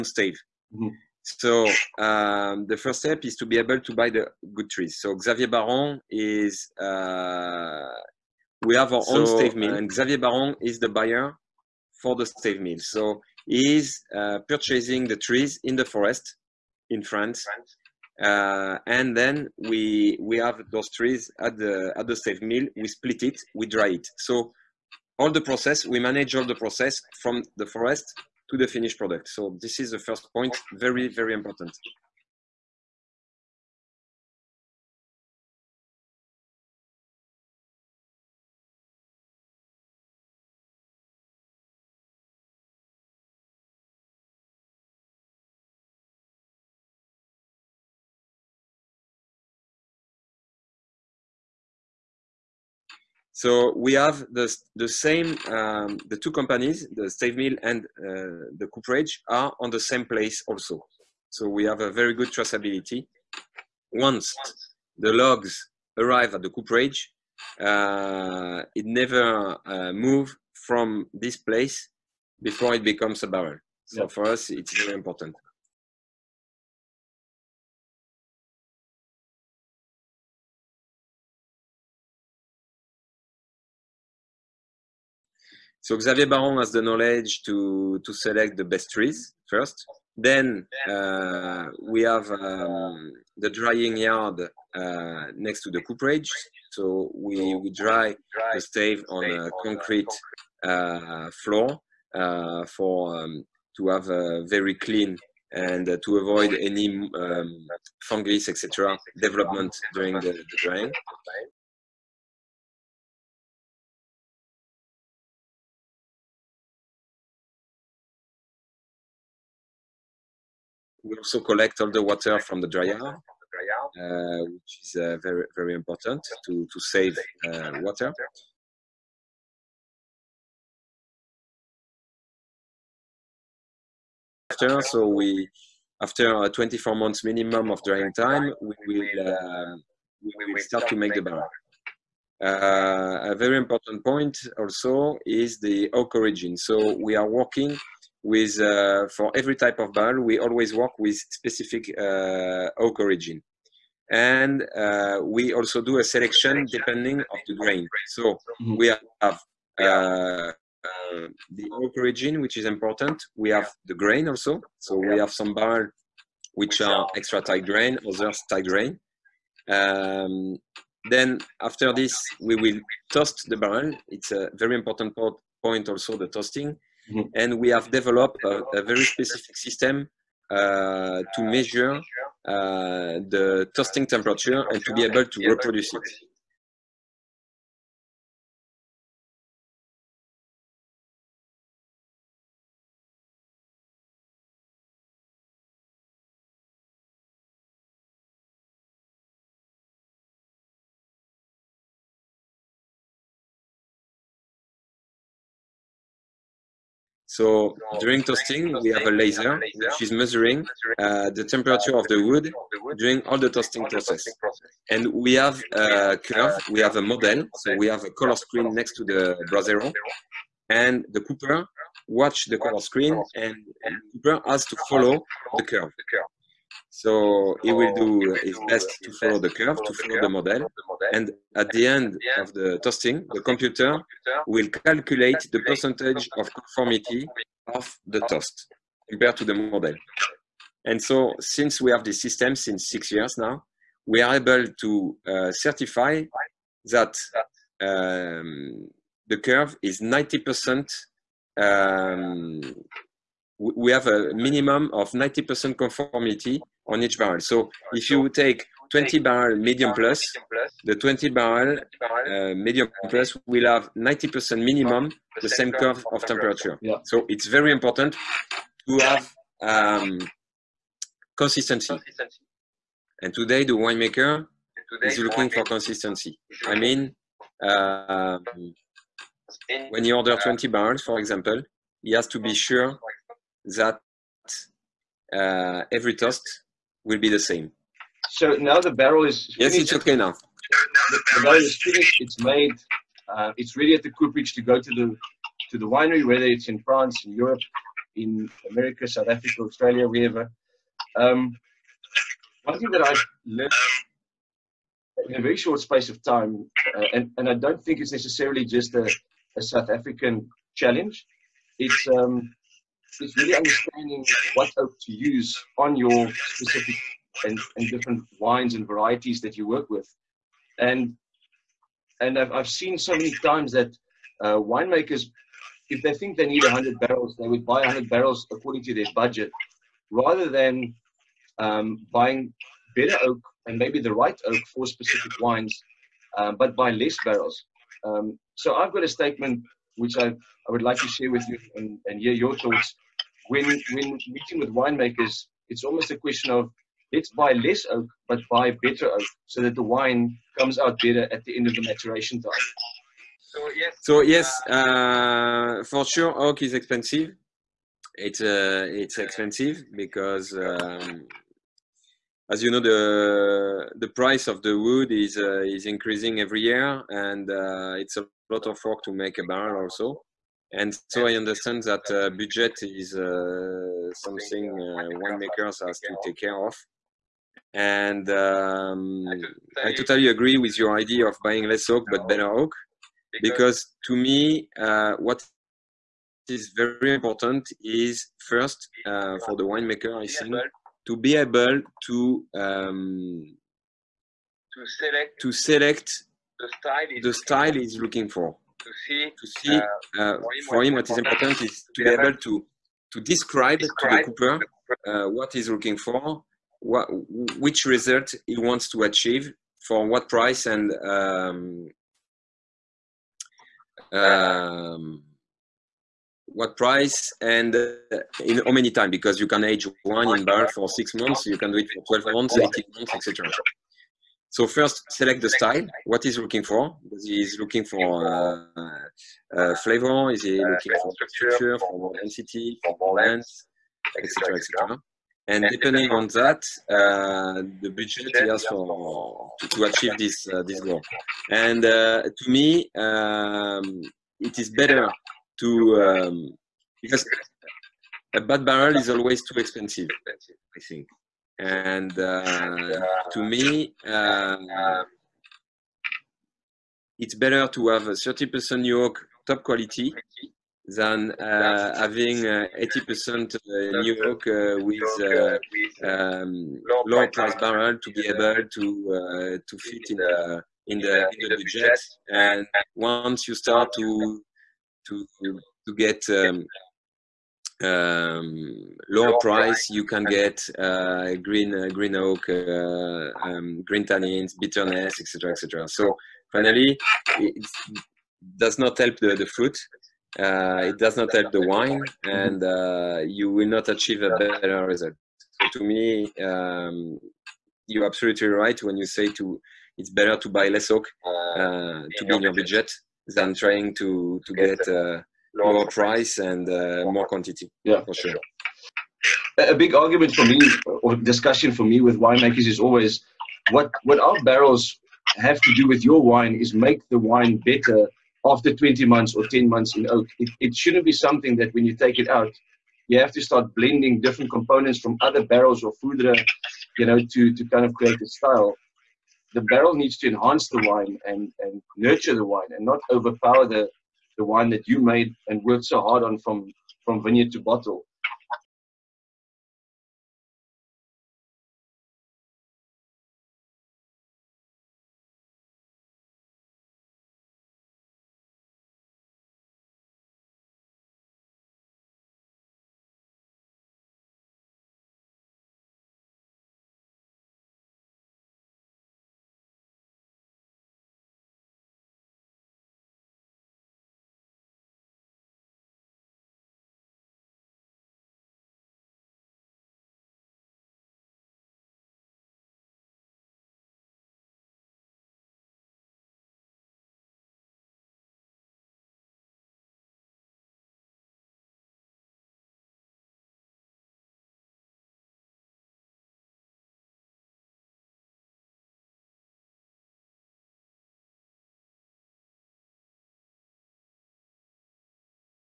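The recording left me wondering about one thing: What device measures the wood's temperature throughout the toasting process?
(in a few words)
A laser.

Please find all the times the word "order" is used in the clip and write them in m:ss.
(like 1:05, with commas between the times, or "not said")
4:40.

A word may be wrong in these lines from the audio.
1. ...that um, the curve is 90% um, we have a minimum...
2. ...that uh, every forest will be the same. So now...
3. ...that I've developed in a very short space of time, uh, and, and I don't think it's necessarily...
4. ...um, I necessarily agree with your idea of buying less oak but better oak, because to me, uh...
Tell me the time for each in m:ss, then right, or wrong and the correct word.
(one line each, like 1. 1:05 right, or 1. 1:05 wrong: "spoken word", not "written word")
1. 4:06 right
2. 4:43 wrong: "toast", not "forest"
3. 5:02 wrong: "learned", not "developed"
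4. 6:18 wrong: "totally", not "necessarily".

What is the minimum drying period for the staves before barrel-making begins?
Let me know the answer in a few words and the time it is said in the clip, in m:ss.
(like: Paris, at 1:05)
24 months, at 2:16.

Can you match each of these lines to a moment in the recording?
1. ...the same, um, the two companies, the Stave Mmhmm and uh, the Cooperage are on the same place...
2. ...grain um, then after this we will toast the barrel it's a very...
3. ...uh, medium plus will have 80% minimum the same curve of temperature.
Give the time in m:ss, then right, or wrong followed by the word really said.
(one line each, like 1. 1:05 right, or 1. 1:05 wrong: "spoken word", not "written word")
1. 0:54 wrong: "Mill", not "Mmhmm"
2. 2:48 right
3. 4:21 wrong: "90", not "80".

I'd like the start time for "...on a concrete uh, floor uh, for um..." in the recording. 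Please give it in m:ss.
1:39.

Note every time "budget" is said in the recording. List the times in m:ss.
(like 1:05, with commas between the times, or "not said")
5:29, 6:12, 7:17, 7:51, 8:22.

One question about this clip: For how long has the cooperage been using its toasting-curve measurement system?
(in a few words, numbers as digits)
6 years.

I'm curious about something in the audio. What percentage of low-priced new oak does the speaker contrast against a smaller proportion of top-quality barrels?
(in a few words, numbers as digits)
80%.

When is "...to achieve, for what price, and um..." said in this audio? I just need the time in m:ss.
6:48.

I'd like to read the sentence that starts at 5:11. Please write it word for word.
It's um, is really understanding what oak to use on your specific and, and different wines and varieties that you work with.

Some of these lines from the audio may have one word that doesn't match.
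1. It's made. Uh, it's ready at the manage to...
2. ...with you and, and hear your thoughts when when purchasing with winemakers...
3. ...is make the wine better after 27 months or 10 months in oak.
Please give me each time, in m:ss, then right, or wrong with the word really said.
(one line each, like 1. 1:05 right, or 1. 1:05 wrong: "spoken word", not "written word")
1. 4:52 wrong: "cooperage", not "manage"
2. 5:41 wrong: "meeting", not "purchasing"
3. 8:36 wrong: "20", not "27".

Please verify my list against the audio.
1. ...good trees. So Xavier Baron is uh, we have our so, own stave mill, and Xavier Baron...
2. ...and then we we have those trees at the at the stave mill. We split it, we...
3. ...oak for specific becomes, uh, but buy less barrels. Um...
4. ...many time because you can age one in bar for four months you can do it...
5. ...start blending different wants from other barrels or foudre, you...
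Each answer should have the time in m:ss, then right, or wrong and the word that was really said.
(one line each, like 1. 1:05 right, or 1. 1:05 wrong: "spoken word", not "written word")
1. 0:04 right
2. 0:18 right
3. 5:34 wrong: "wines", not "becomes"
4. 6:58 wrong: "six", not "four"
5. 8:43 wrong: "components", not "wants".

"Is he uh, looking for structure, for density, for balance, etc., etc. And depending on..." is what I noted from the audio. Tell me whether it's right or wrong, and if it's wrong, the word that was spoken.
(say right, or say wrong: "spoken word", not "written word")
right.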